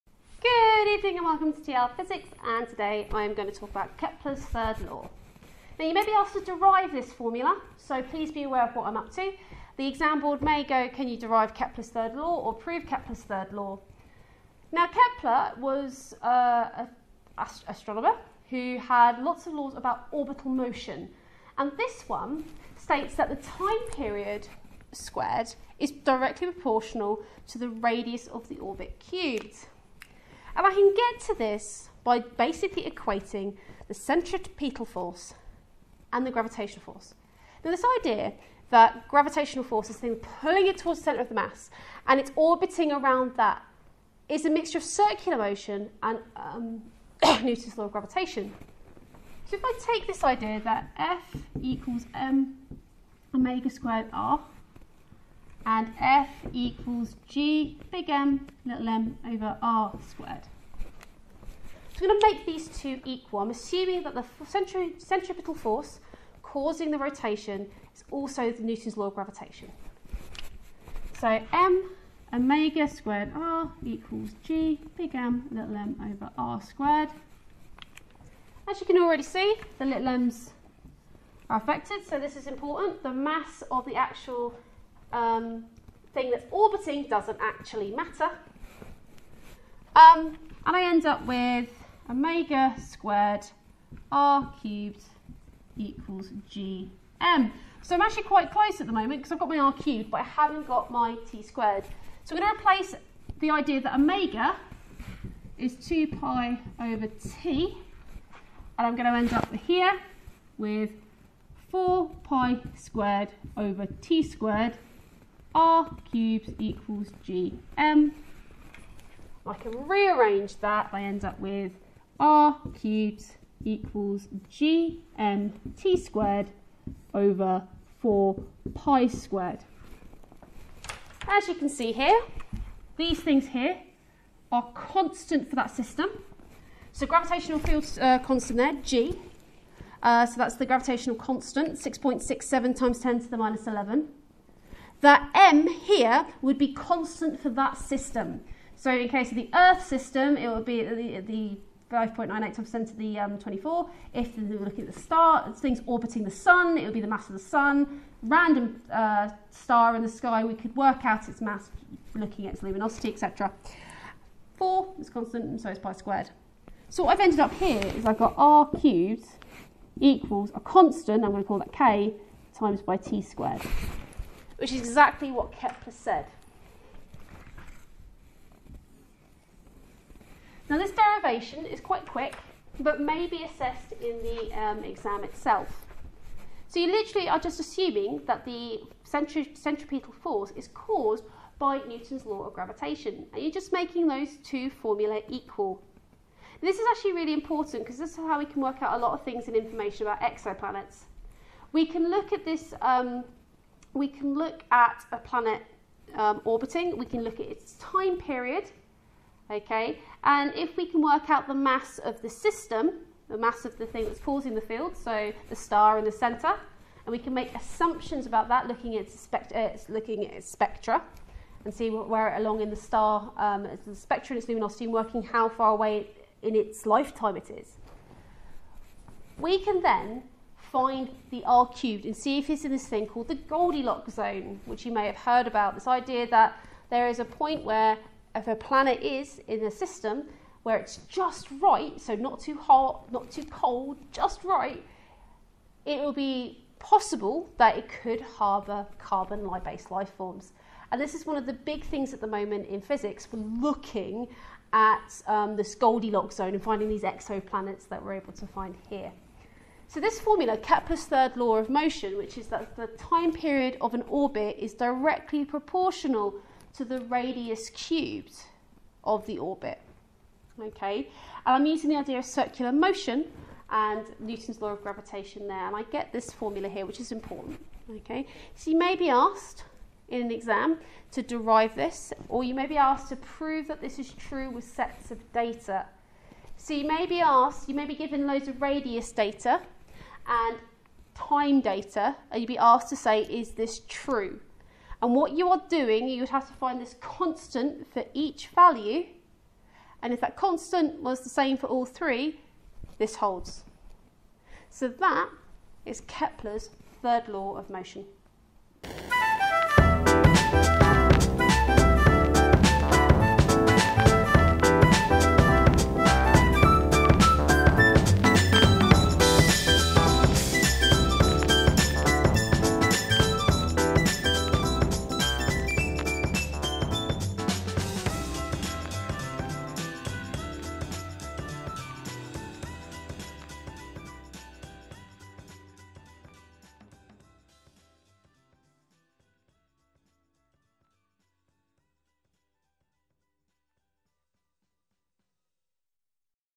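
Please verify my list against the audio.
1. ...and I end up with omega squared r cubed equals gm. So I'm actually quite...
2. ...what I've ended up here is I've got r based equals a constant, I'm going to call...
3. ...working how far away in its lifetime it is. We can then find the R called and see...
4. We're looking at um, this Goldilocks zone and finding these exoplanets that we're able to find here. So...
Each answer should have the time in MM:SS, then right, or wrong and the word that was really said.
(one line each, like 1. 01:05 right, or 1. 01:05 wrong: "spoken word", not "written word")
1. 01:30 right
2. 02:47 wrong: "cubed", not "based"
3. 03:44 wrong: "cubed", not "called"
4. 04:13 right.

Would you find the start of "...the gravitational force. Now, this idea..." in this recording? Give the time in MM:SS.
00:36.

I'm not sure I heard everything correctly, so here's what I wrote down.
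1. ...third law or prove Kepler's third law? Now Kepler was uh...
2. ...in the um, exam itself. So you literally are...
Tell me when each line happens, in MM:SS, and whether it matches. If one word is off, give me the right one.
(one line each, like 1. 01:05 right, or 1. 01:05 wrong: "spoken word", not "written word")
1. 00:11 right
2. 03:03 right.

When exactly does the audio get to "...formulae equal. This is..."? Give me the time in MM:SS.
03:14.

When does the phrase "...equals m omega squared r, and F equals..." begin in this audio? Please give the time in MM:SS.
00:51.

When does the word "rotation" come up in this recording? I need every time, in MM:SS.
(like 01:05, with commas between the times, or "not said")
01:06.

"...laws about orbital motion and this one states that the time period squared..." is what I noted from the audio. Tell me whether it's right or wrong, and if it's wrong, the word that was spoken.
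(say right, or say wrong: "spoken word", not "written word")
right.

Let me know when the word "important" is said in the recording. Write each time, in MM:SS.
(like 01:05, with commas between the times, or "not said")
01:22, 03:17, 04:37.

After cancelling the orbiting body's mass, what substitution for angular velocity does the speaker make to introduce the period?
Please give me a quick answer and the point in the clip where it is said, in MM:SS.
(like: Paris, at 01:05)
2 pi over T, at 01:45.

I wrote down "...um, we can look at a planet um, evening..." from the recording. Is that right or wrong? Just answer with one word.
wrong.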